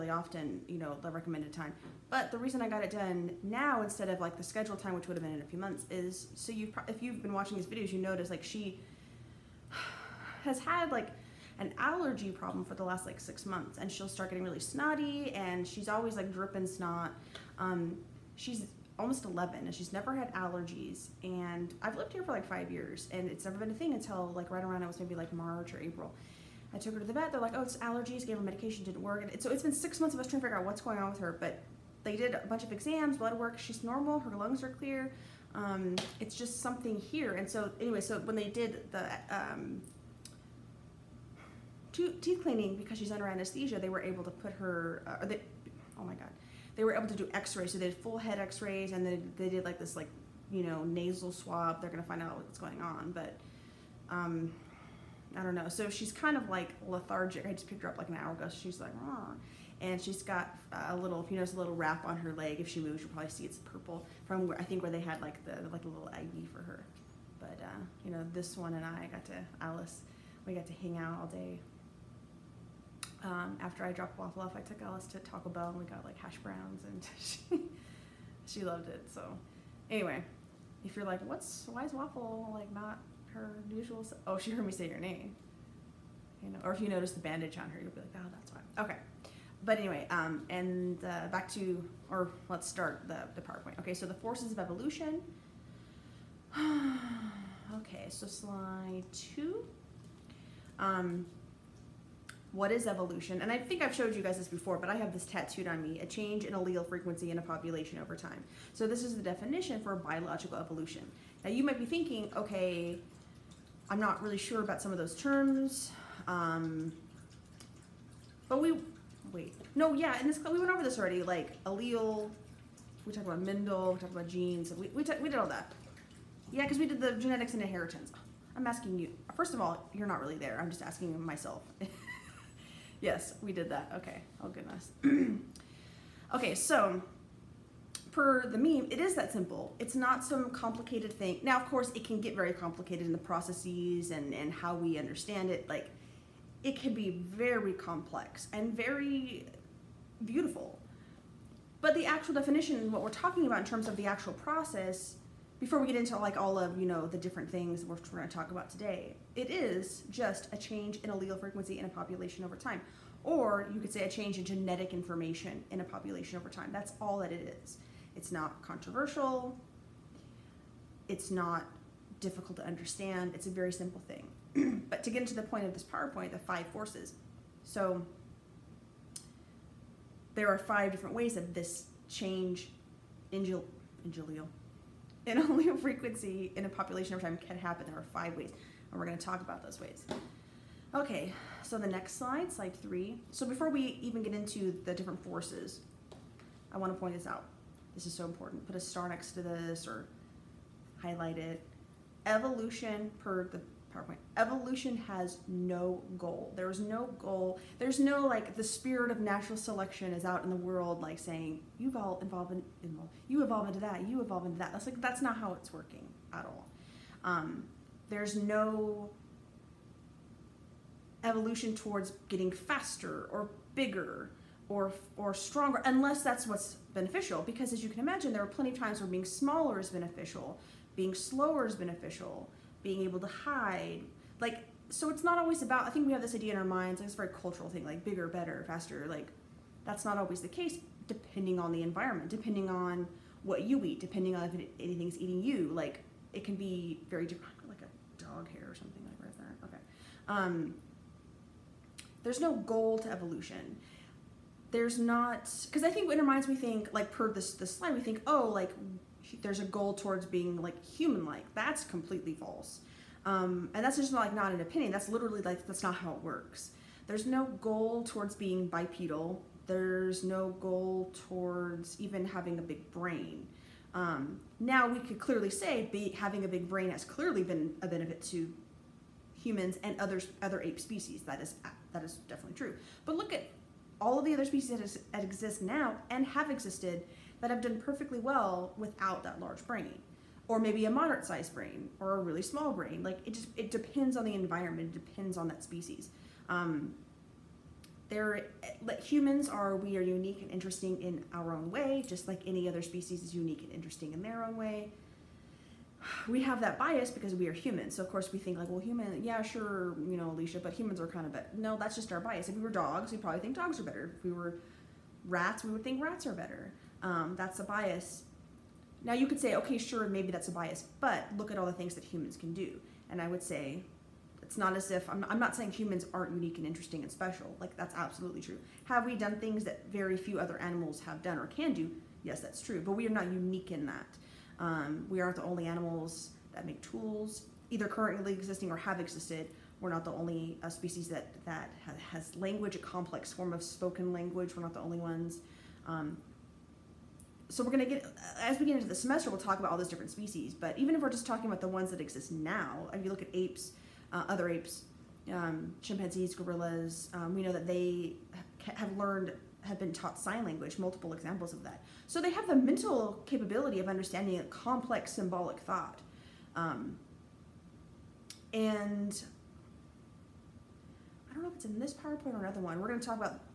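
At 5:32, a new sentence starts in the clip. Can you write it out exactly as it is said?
Yes, that's true, but we are not unique in that.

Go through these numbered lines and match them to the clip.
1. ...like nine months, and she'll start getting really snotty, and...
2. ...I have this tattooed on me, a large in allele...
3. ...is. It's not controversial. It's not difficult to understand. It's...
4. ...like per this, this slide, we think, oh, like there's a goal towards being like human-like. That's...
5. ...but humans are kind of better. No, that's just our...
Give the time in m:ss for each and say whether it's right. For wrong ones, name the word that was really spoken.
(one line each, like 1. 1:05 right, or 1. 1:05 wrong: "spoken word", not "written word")
1. 0:13 wrong: "six", not "nine"
2. 1:44 wrong: "change", not "large"
3. 2:47 right
4. 4:16 right
5. 5:10 right.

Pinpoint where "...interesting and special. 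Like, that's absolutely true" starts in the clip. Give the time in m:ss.
5:26.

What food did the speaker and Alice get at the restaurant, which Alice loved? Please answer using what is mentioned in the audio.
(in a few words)
Hash browns.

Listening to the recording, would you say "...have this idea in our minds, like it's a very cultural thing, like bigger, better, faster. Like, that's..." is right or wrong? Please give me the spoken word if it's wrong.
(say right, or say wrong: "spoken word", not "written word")
right.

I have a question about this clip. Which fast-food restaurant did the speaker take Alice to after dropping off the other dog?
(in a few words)
Taco Bell.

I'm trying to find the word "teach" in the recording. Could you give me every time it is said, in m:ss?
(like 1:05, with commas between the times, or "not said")
not said.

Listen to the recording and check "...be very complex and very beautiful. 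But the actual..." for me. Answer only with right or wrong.
right.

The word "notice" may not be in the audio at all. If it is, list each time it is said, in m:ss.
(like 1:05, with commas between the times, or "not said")
0:07, 1:01, 1:26.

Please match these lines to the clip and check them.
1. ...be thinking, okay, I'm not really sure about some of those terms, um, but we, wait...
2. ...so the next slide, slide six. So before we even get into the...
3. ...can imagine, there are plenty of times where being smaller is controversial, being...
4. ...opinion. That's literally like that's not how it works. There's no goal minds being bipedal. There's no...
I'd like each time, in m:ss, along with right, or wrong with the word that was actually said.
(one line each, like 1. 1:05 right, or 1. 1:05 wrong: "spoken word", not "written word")
1. 1:51 right
2. 3:11 wrong: "three", not "six"
3. 3:47 wrong: "beneficial", not "controversial"
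4. 4:24 wrong: "towards", not "minds".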